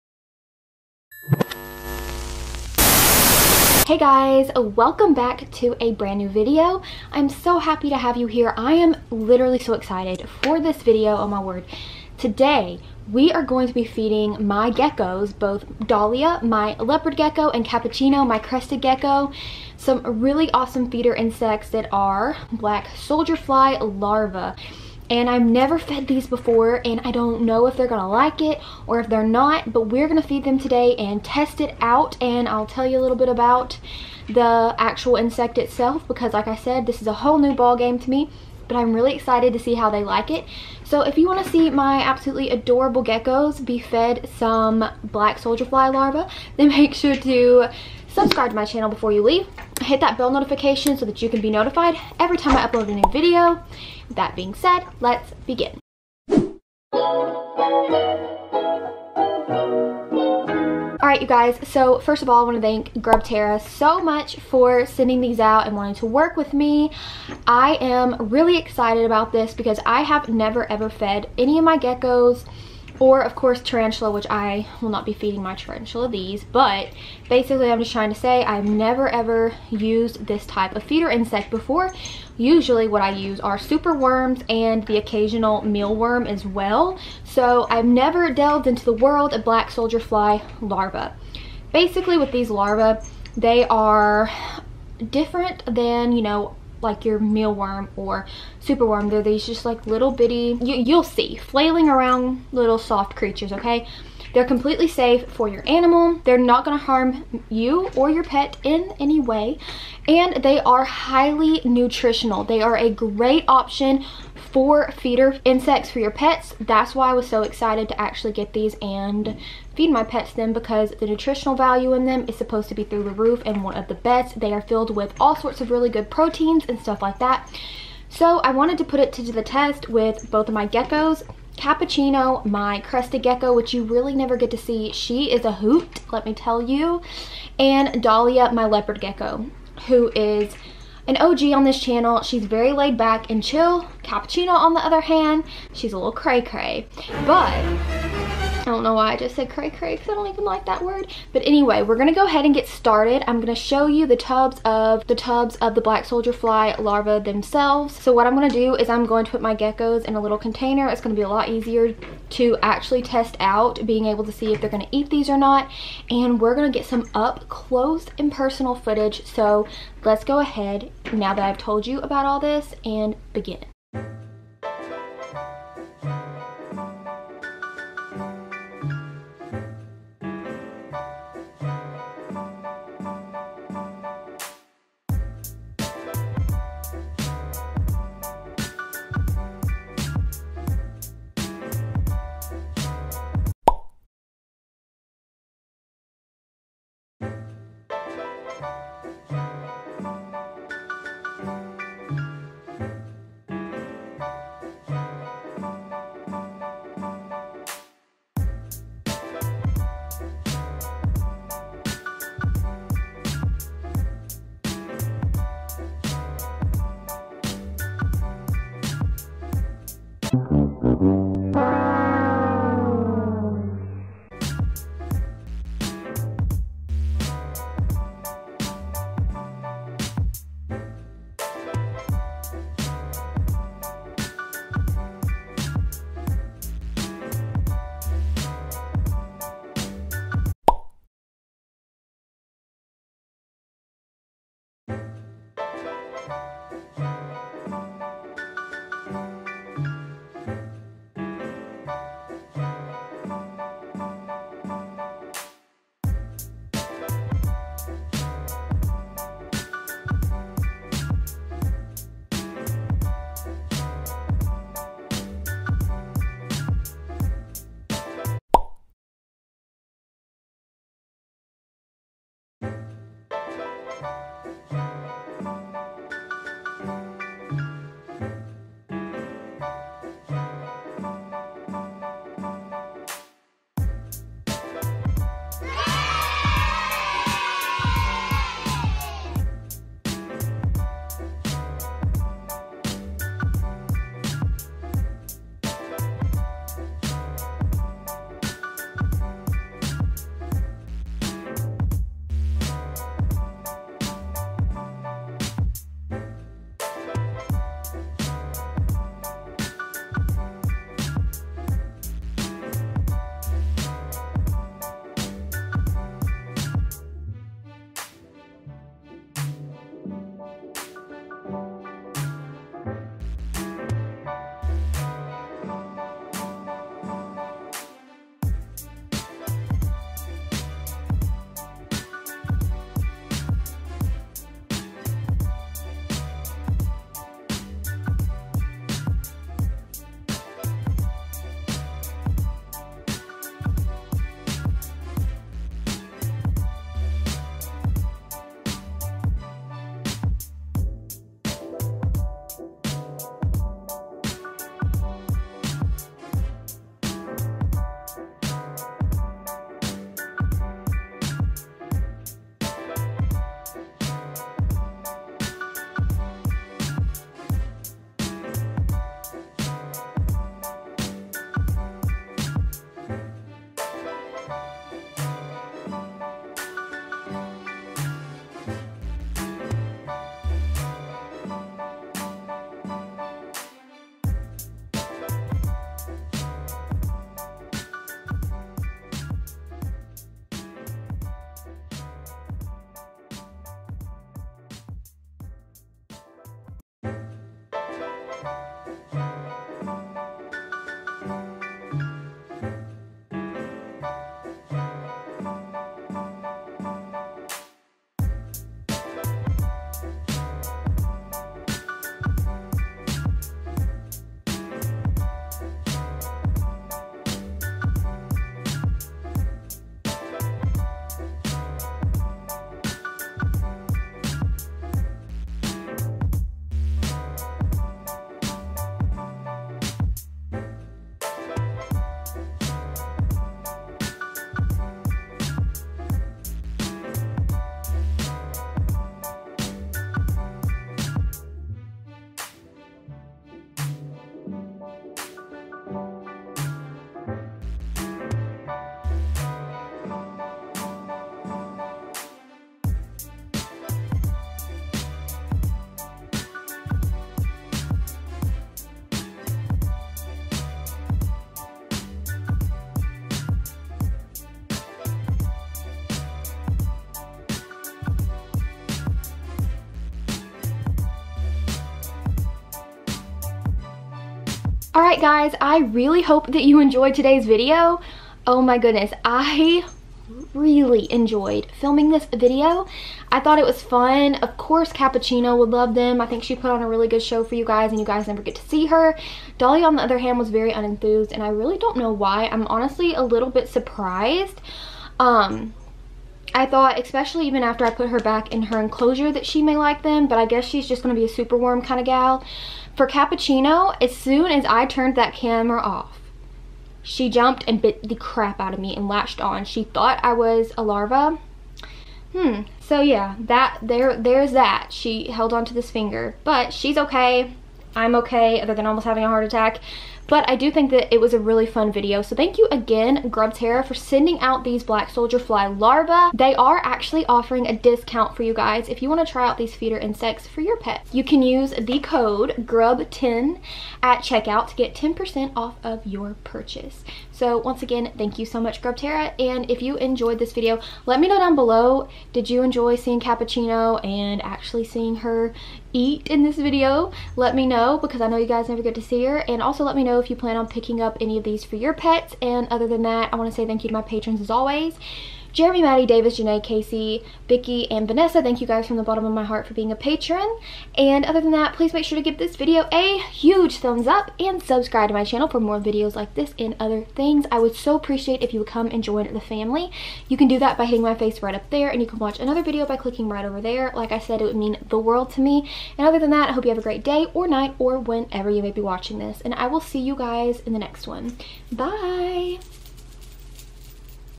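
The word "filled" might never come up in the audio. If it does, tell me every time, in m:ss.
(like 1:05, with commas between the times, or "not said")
2:04.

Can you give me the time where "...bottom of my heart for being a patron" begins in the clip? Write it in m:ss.
9:19.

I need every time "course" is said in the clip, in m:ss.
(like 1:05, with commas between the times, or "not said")
1:13, 8:04.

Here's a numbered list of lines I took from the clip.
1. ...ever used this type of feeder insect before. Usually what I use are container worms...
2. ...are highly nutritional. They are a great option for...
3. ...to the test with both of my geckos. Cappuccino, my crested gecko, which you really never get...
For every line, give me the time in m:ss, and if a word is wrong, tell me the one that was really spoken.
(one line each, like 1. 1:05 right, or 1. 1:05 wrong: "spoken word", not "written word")
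1. 1:19 wrong: "super", not "container"
2. 1:50 right
3. 2:09 right.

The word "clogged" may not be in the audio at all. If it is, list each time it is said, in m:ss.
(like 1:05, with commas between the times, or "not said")
not said.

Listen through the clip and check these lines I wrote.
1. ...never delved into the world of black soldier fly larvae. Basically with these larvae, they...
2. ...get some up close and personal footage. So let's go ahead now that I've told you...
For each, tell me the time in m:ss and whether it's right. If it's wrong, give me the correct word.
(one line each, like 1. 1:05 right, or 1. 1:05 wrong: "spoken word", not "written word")
1. 1:27 right
2. 2:46 right.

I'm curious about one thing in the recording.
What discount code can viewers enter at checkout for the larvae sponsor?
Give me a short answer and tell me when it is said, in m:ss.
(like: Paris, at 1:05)
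GRUB10, at 8:52.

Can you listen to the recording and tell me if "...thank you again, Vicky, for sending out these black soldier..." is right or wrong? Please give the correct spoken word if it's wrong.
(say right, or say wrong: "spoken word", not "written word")
wrong: "Grubterra", not "Vicky".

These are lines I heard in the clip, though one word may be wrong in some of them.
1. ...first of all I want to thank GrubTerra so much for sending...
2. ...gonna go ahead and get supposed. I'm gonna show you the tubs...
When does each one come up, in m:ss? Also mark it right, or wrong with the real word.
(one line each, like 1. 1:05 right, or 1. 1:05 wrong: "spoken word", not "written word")
1. 1:01 right
2. 2:31 wrong: "started", not "supposed".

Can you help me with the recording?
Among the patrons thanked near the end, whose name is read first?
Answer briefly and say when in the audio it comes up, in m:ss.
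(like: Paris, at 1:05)
Jeremy, at 9:15.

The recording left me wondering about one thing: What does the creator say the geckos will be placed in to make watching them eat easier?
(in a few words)
a little container.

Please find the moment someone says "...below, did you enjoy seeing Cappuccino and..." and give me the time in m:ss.
9:01.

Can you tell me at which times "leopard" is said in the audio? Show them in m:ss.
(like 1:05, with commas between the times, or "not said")
0:16, 2:18.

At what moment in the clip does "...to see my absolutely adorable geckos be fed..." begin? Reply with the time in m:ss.
0:41.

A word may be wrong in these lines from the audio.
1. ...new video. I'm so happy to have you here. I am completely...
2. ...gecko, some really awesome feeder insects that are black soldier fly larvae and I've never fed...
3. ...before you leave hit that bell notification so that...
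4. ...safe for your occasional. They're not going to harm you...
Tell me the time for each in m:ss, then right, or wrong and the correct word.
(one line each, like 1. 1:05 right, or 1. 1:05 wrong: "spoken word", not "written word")
1. 0:06 wrong: "literally", not "completely"
2. 0:18 right
3. 0:48 right
4. 1:44 wrong: "animal", not "occasional".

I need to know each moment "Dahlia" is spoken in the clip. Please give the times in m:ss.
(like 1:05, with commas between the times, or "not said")
0:15, 2:18, 8:09.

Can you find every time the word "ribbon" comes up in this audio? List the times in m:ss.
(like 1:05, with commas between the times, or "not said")
not said.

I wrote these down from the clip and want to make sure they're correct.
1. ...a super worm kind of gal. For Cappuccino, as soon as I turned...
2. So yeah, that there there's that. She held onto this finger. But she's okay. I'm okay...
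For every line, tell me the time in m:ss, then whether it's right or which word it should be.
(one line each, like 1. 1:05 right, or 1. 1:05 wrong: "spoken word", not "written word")
1. 8:21 right
2. 8:32 right.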